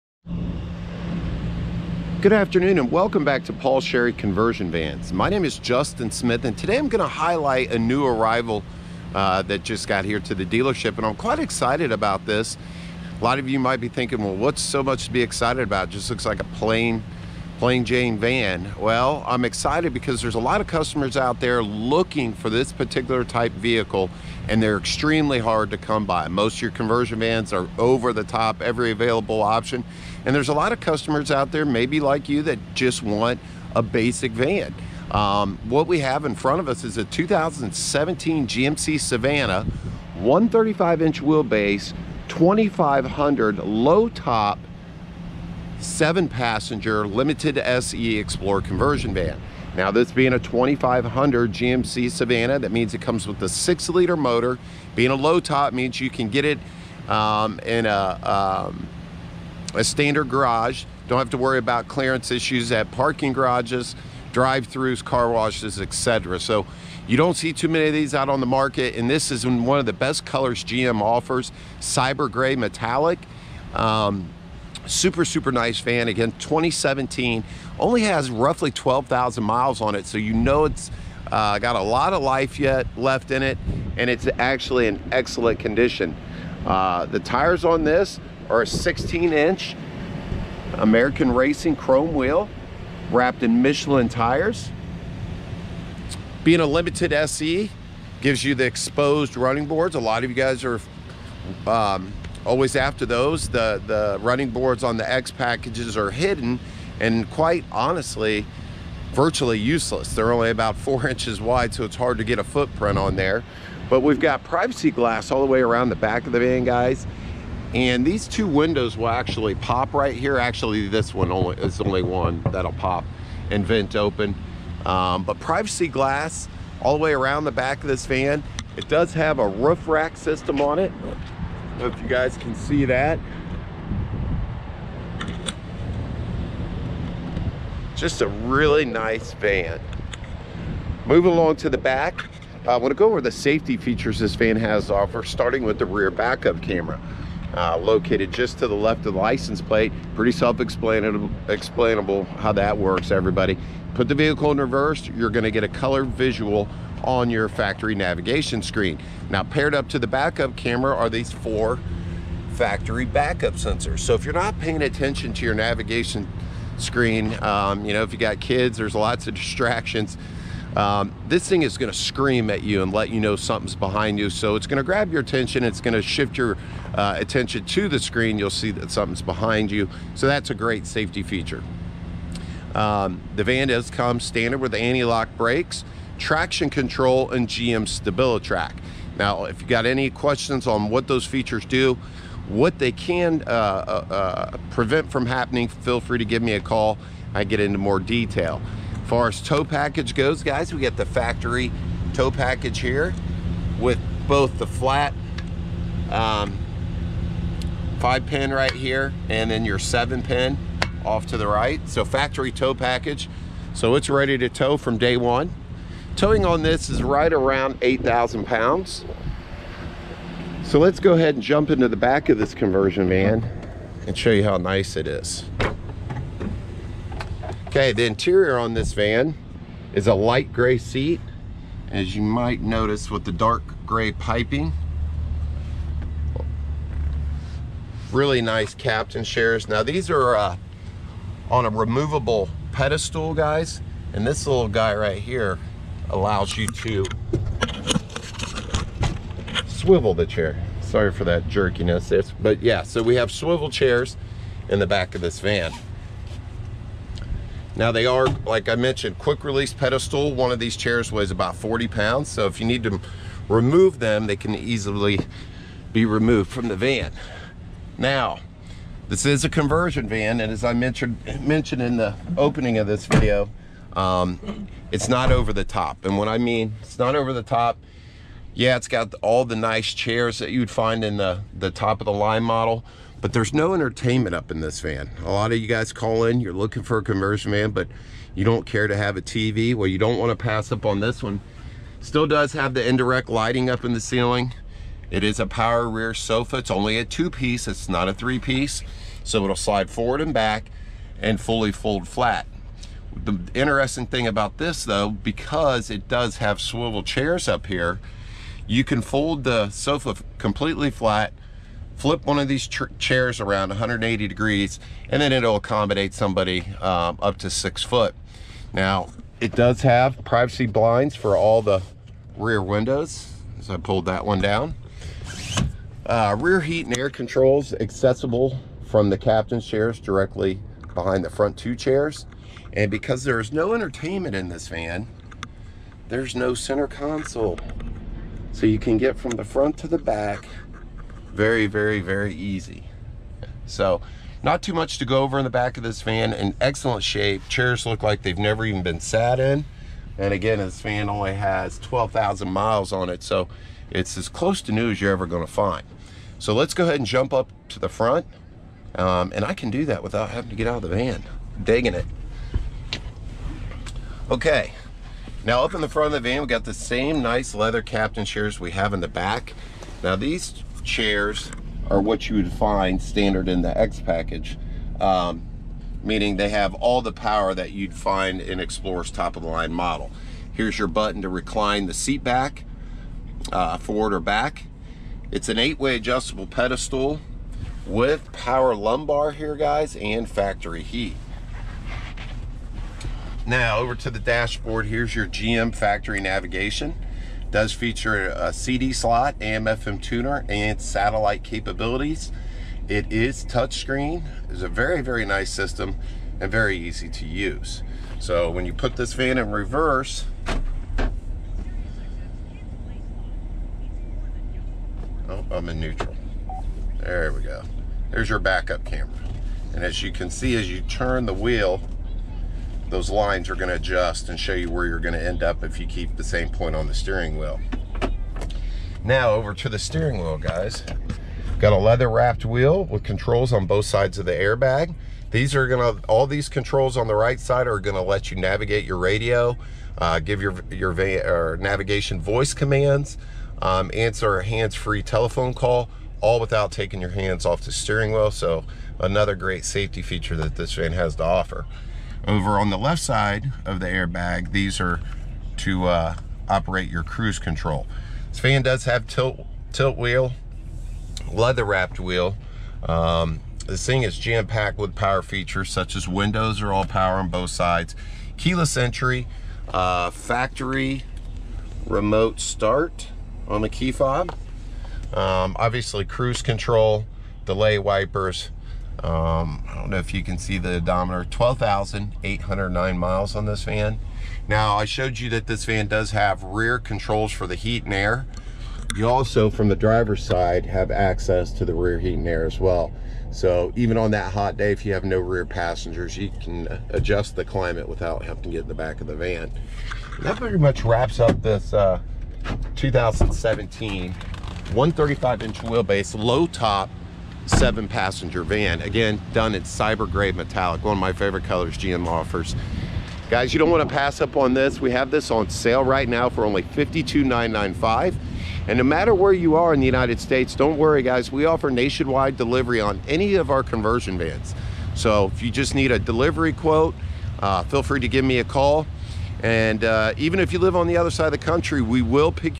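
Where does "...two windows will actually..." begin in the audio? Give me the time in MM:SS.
01:58.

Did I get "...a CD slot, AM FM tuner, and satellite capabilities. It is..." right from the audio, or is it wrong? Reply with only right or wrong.
right.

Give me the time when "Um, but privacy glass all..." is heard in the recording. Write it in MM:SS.
02:04.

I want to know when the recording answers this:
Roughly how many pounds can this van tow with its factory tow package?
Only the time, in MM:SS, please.
03:37.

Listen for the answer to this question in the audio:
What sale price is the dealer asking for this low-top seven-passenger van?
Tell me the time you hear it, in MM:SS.
08:36.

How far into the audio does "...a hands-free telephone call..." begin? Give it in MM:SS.
07:24.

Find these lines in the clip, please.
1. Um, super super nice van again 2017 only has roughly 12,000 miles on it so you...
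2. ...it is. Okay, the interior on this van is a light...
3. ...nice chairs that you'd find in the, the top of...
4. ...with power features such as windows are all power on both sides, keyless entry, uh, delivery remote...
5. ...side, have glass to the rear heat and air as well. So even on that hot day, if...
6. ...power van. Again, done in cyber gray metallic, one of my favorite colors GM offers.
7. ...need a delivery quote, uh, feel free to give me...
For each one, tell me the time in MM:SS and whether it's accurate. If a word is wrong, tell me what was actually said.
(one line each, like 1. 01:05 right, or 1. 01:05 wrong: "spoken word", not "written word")
1. 01:13 right
2. 03:44 right
3. 04:39 right
4. 07:44 wrong: "factory", not "delivery"
5. 08:10 wrong: "access", not "glass"
6. 08:27 wrong: "passenger", not "power"
7. 08:45 right.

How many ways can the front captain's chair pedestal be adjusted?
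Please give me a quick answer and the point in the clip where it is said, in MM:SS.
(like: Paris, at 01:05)
8-way, at 06:25.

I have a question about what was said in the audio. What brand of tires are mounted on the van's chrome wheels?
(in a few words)
Michelin.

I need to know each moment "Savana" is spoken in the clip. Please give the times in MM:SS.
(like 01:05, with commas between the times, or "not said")
00:38, 00:52.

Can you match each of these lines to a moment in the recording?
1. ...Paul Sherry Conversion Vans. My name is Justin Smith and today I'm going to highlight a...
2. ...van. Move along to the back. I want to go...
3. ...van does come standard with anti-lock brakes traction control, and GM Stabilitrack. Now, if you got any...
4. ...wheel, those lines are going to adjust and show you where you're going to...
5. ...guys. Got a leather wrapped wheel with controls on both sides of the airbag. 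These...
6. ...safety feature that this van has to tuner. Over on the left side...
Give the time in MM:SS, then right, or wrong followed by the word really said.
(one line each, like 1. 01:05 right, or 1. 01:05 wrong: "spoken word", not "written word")
1. 00:03 right
2. 02:19 right
3. 03:03 right
4. 07:01 right
5. 07:10 right
6. 07:29 wrong: "offer", not "tuner".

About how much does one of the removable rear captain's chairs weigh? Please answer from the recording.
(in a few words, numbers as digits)
40 pounds.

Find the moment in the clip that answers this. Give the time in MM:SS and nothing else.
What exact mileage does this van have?
08:01.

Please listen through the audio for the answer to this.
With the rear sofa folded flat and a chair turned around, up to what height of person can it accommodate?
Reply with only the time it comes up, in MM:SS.
05:17.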